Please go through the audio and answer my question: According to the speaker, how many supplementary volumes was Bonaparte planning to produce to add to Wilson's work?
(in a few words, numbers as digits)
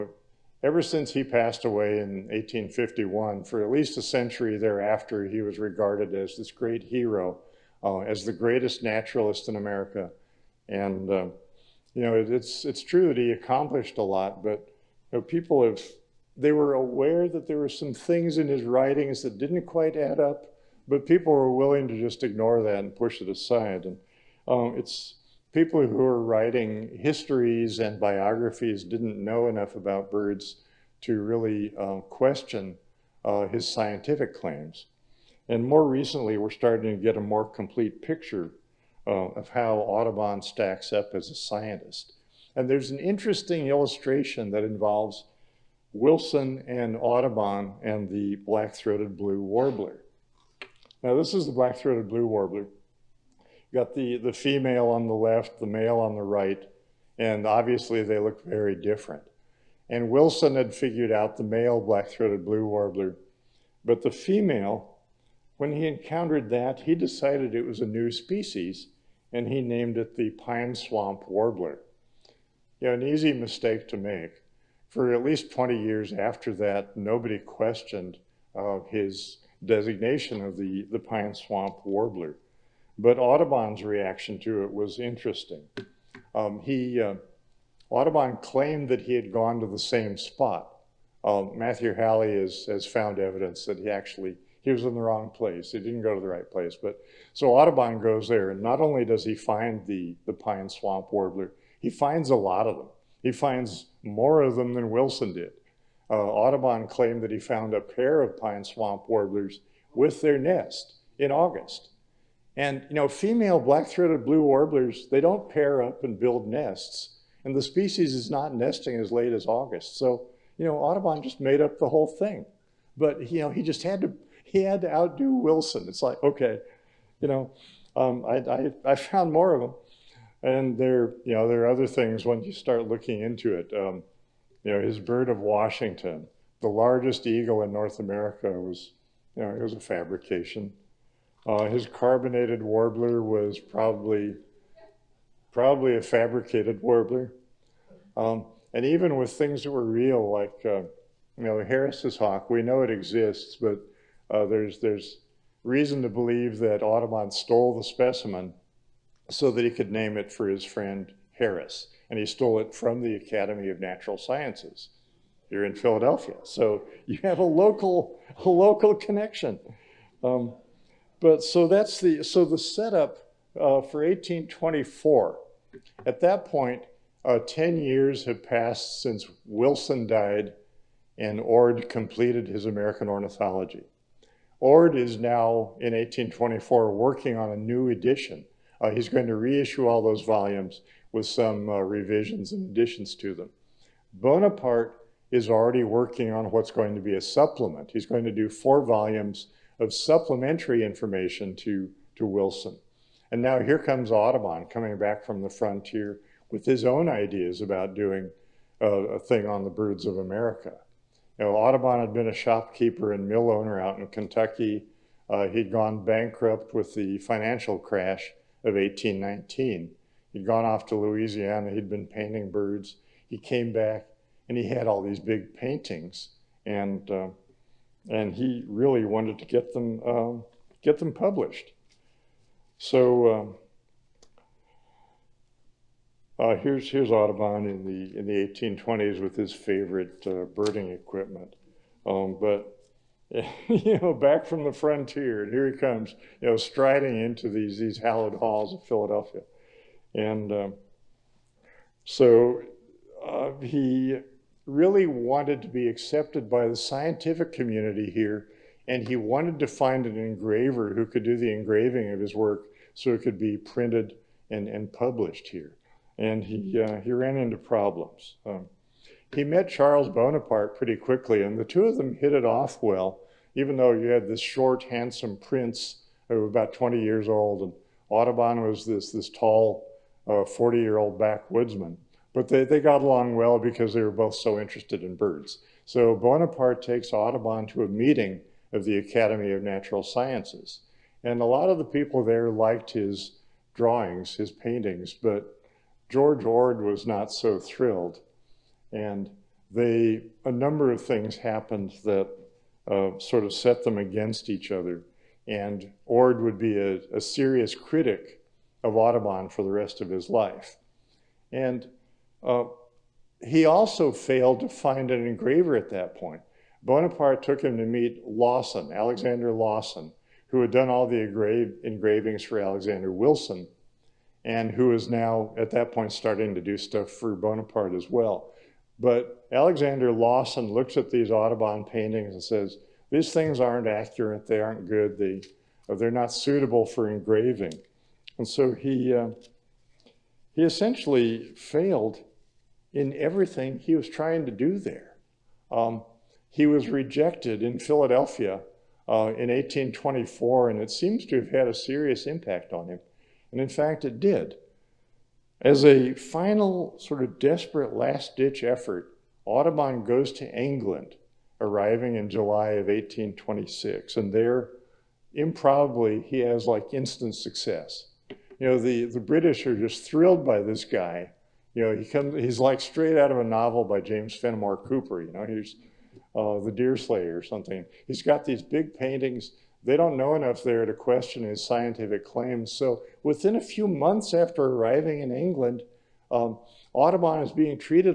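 4.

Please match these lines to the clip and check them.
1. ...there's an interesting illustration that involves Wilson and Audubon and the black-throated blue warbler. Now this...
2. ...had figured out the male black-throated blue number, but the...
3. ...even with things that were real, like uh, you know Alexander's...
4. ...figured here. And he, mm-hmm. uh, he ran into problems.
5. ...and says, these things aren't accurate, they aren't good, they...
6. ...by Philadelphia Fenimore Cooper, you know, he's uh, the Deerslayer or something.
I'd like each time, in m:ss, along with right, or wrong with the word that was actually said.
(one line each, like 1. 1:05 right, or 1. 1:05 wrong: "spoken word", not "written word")
1. 0:42 right
2. 1:00 wrong: "warbler", not "number"
3. 2:28 wrong: "Harris", not "Alexander"
4. 4:24 wrong: "published", not "figured"
5. 5:32 right
6. 6:13 wrong: "James", not "Philadelphia".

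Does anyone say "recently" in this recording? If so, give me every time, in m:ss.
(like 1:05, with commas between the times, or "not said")
0:35.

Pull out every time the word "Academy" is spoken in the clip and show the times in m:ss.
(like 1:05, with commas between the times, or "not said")
2:43, 4:48.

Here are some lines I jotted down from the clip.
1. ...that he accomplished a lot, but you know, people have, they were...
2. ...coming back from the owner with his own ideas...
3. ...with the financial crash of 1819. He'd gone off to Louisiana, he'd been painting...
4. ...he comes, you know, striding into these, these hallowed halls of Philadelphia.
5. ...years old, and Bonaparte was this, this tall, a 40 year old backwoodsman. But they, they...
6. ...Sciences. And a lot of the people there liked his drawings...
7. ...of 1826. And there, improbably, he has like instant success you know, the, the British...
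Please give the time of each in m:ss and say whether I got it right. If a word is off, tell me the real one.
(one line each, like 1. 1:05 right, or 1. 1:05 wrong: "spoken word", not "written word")
1. 0:13 right
2. 3:24 wrong: "frontier", not "owner"
3. 3:36 right
4. 4:05 right
5. 4:37 wrong: "Audubon", not "Bonaparte"
6. 4:50 right
7. 6:02 right.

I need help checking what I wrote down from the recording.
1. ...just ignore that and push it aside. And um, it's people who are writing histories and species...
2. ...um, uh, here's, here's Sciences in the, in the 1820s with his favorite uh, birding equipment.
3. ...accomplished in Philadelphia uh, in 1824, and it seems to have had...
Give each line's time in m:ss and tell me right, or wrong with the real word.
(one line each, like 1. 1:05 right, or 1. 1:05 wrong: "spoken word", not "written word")
1. 0:21 wrong: "biographies", not "species"
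2. 3:53 wrong: "Audubon", not "Sciences"
3. 5:46 wrong: "rejected", not "accomplished".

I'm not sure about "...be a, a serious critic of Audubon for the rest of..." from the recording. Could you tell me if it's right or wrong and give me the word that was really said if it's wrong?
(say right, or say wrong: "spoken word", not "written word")
right.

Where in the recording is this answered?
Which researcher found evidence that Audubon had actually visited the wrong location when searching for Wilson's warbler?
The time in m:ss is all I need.
1:31.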